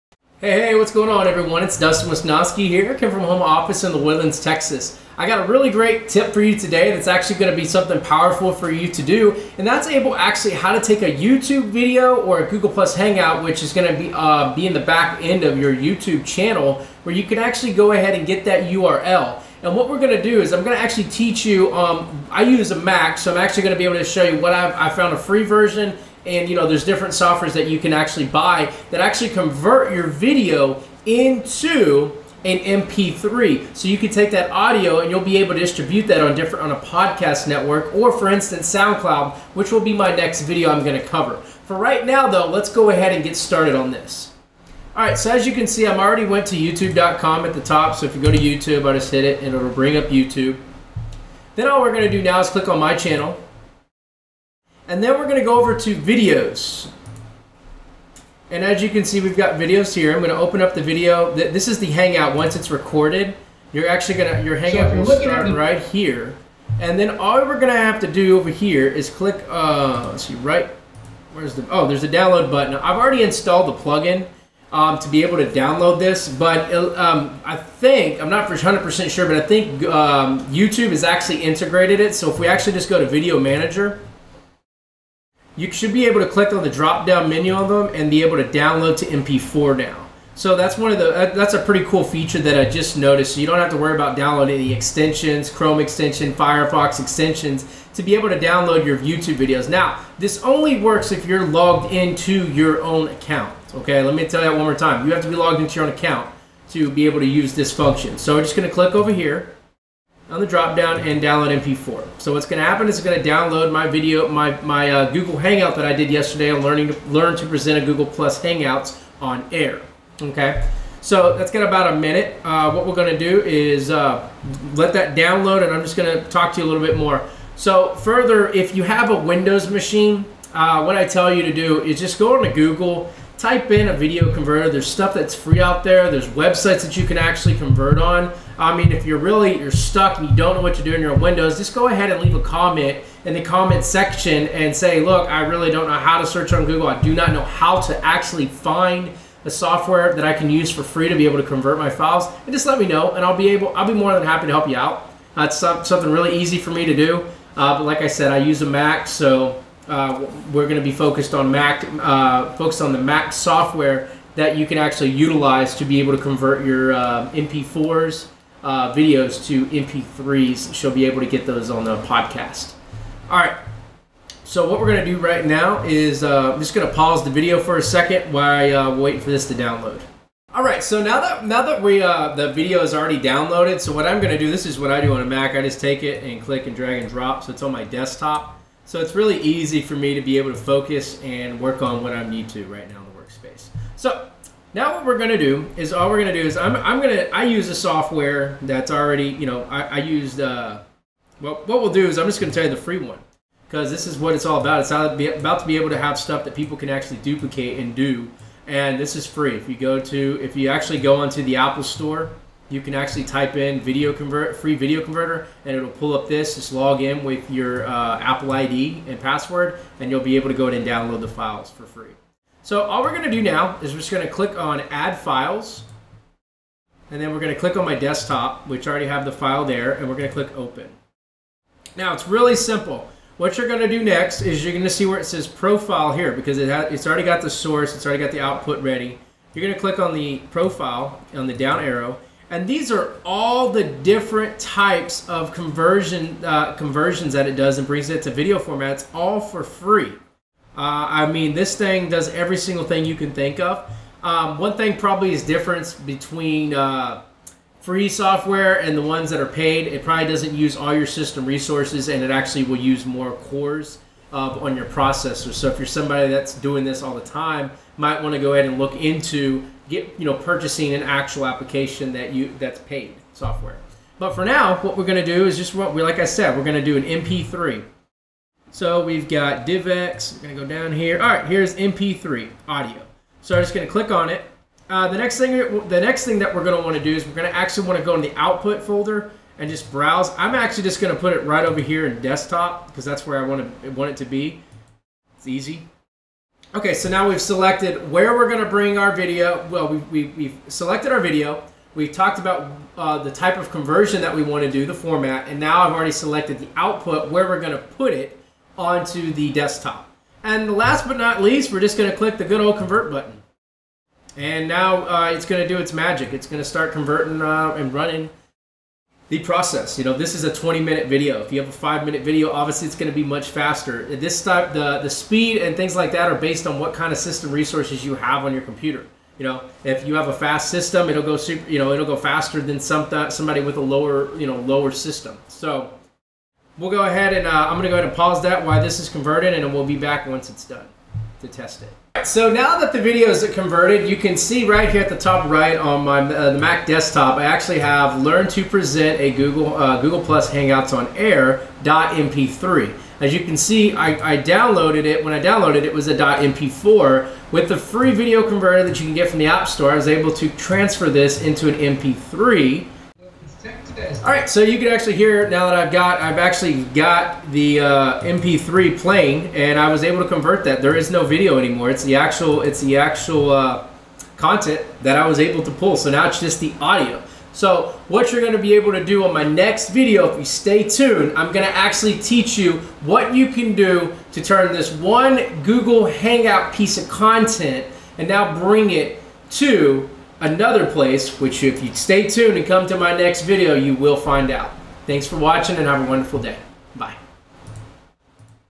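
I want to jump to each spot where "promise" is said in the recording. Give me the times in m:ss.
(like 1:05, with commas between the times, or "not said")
not said.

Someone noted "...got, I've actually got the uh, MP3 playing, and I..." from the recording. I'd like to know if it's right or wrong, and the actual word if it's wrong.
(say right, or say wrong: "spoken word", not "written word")
right.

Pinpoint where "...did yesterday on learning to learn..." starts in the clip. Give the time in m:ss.
1:55.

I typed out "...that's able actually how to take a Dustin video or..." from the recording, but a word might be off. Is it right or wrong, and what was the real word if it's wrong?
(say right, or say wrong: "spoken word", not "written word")
wrong: "YouTube", not "Dustin".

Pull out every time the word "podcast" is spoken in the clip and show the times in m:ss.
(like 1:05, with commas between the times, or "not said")
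0:36, 2:52.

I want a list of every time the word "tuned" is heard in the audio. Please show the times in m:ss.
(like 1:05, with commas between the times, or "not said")
6:20, 6:32.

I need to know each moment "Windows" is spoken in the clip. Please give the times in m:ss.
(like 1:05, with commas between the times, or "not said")
2:09, 2:21.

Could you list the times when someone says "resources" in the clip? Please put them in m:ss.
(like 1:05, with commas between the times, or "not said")
4:21, 5:27.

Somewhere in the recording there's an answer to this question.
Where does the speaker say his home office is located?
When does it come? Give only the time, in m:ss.
0:03.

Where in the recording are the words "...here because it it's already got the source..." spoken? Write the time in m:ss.
3:56.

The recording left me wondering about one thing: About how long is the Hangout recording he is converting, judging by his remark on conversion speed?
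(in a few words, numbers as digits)
20 minutes.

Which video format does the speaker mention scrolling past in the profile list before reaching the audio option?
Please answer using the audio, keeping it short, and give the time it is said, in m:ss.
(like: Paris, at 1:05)
DivX, at 4:39.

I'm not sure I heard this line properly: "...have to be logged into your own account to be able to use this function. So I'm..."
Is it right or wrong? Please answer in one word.
right.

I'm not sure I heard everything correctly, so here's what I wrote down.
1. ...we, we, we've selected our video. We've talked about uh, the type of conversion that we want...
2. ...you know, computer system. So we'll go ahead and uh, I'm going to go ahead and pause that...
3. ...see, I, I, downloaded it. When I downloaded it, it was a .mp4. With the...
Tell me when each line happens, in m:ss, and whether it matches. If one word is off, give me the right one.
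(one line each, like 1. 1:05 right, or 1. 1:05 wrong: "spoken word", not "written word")
1. 4:59 right
2. 5:34 wrong: "lower", not "computer"
3. 5:53 right.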